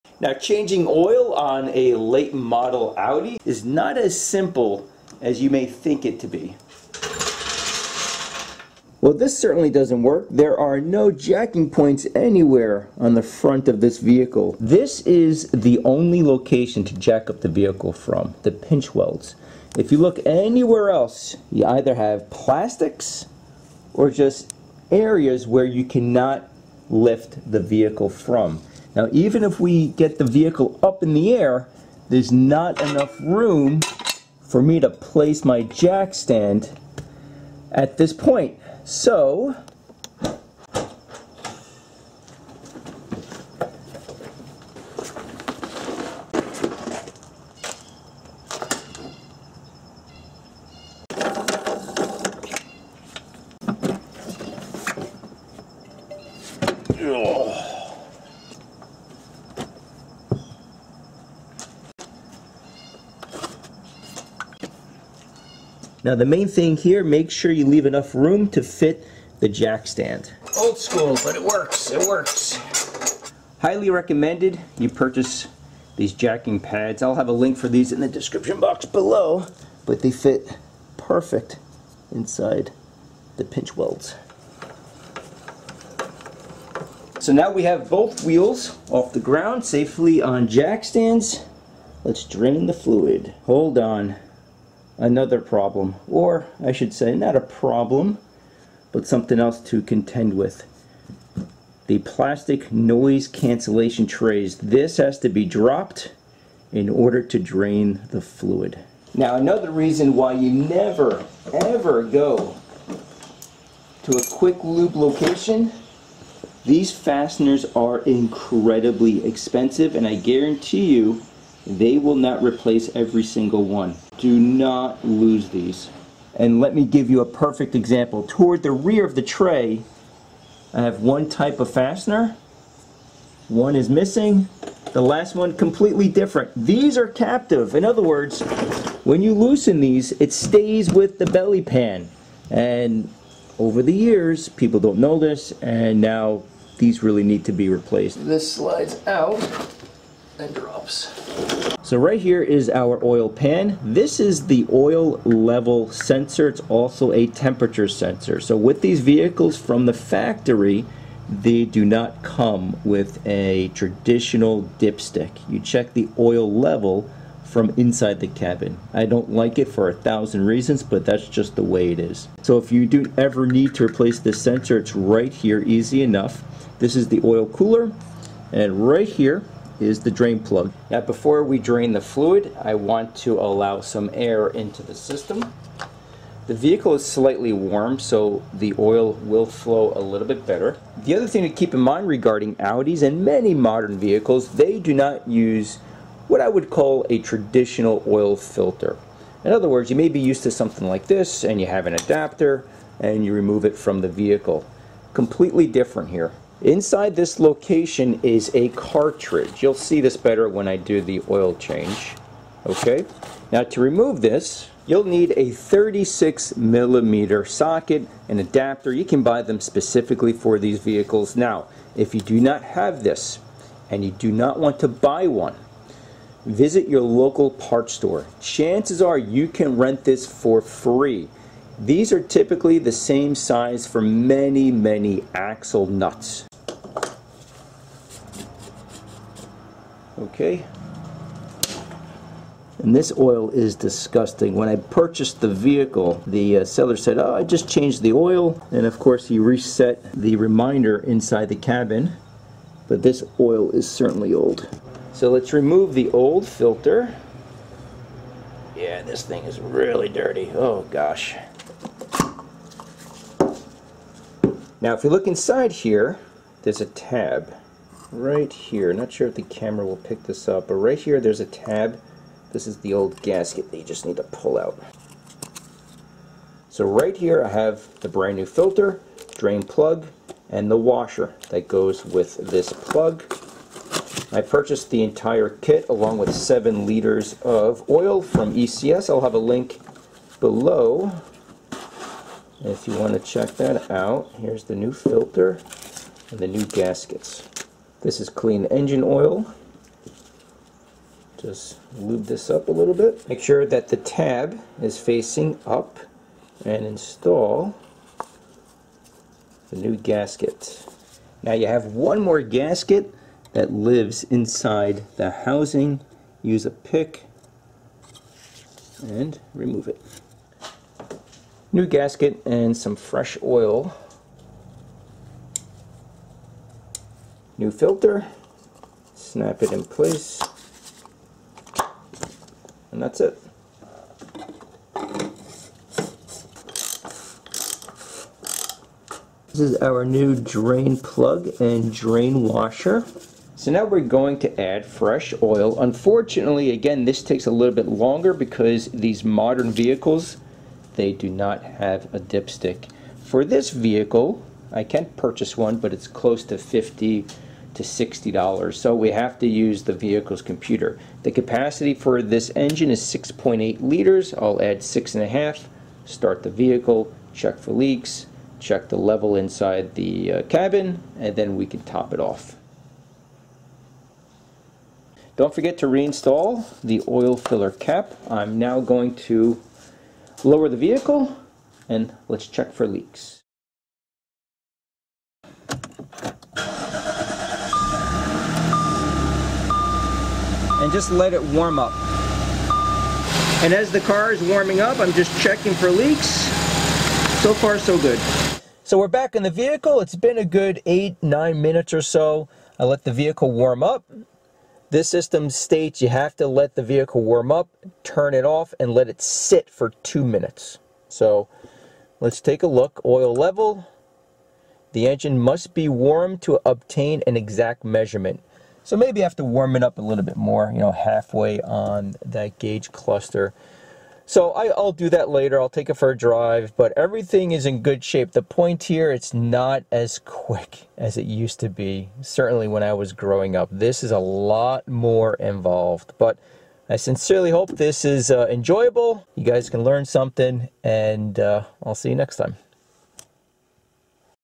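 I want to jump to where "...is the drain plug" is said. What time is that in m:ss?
2:59.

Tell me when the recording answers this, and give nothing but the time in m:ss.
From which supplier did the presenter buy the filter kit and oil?
4:48.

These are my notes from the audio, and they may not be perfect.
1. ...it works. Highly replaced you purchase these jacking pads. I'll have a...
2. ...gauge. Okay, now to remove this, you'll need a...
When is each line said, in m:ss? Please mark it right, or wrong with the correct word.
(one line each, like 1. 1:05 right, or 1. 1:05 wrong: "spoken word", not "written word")
1. 1:11 wrong: "recommended", not "replaced"
2. 3:31 wrong: "change", not "gauge".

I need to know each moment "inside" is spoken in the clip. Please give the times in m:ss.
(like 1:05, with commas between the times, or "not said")
1:22, 2:47, 3:26, 4:10, 4:25, 5:14, 6:09.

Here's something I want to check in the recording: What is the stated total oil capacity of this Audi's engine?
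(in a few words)
6.8 liters.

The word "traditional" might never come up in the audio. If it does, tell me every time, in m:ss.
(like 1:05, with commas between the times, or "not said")
2:43, 3:17.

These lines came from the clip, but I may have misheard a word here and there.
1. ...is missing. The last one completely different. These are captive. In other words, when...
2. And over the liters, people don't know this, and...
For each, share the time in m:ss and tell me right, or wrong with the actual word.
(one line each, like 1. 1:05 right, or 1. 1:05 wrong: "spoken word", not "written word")
1. 2:13 right
2. 2:22 wrong: "years", not "liters".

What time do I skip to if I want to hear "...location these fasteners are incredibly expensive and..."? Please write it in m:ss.
1:54.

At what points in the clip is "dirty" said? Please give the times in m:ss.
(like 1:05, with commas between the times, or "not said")
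4:20.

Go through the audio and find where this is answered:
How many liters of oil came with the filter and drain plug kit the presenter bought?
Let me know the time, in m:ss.
4:46.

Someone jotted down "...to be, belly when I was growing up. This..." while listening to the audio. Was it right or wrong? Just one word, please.
wrong.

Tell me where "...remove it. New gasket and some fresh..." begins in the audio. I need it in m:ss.
5:19.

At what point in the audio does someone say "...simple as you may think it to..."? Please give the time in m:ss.
0:04.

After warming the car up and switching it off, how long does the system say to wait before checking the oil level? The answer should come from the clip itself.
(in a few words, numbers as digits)
2 minutes.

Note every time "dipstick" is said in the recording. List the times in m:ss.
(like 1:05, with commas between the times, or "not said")
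2:44, 5:52.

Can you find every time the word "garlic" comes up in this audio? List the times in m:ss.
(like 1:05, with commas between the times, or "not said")
not said.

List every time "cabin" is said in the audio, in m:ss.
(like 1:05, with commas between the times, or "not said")
2:48, 4:11, 6:10.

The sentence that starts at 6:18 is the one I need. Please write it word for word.
I'm now going to lower the vehicle and let's check for leaks.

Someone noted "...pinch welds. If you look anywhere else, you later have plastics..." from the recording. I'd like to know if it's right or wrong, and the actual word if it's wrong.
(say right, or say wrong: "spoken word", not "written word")
wrong: "either", not "later".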